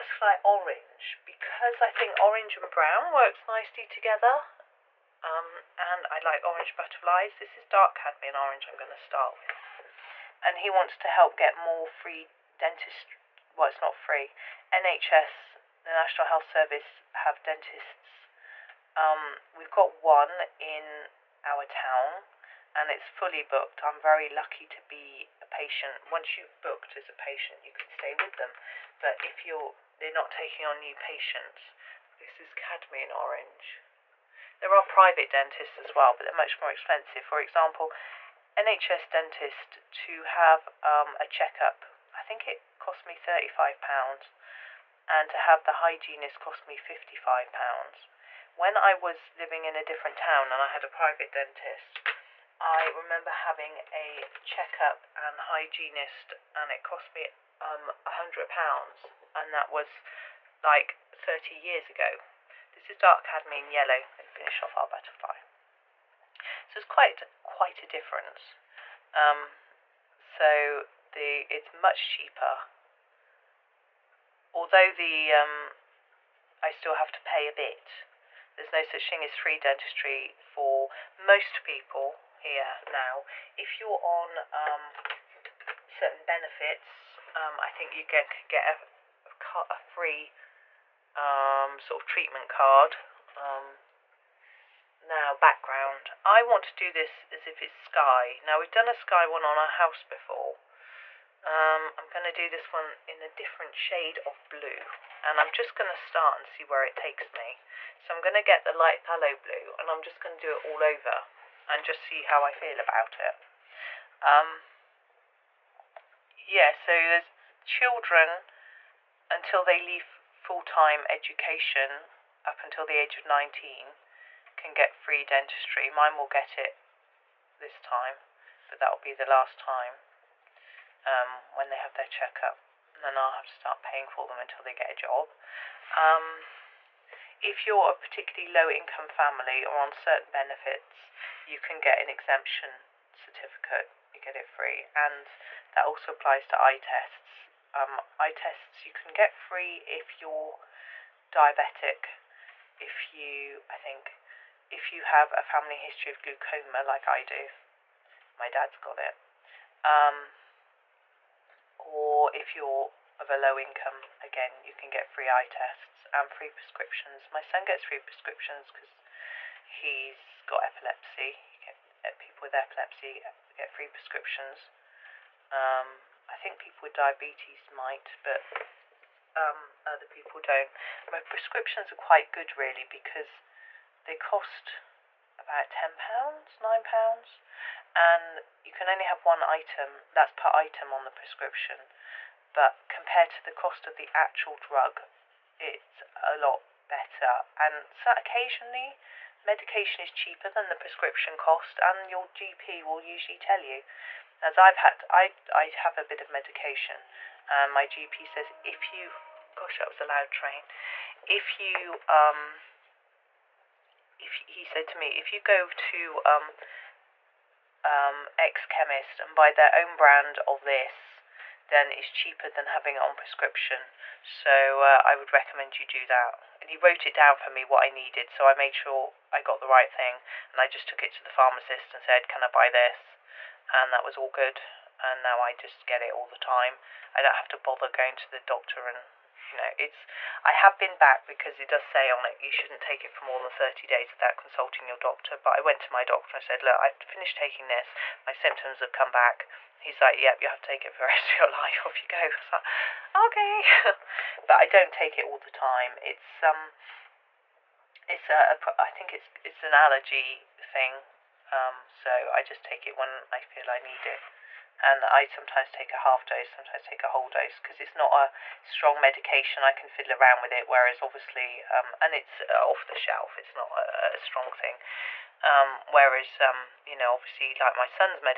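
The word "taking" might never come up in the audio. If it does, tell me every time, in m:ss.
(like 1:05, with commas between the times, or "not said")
0:30, 4:07.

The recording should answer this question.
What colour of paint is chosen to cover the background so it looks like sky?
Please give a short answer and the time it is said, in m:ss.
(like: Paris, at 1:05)
Light phthalo blue, at 1:48.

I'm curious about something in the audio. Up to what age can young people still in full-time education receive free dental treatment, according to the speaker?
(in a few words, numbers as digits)
19.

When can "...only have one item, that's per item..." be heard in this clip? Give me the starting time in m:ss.
3:08.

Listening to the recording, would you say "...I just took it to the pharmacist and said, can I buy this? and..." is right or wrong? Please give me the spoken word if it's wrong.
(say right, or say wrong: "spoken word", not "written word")
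right.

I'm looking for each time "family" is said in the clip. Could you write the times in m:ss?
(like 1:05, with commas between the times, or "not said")
2:19, 2:35.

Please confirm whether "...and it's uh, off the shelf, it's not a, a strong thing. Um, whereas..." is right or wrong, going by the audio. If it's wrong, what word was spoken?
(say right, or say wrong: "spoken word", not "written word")
right.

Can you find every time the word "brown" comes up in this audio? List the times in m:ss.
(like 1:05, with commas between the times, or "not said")
0:02.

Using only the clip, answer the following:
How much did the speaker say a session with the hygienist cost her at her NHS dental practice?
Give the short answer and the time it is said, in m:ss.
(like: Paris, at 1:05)
£55, at 0:46.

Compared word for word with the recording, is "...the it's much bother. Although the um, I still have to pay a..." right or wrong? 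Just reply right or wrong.
wrong.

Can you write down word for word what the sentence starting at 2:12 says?
And then I'll have to start paying for them until they get a job.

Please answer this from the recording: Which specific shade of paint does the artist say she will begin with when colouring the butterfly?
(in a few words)
Dark cadmium orange.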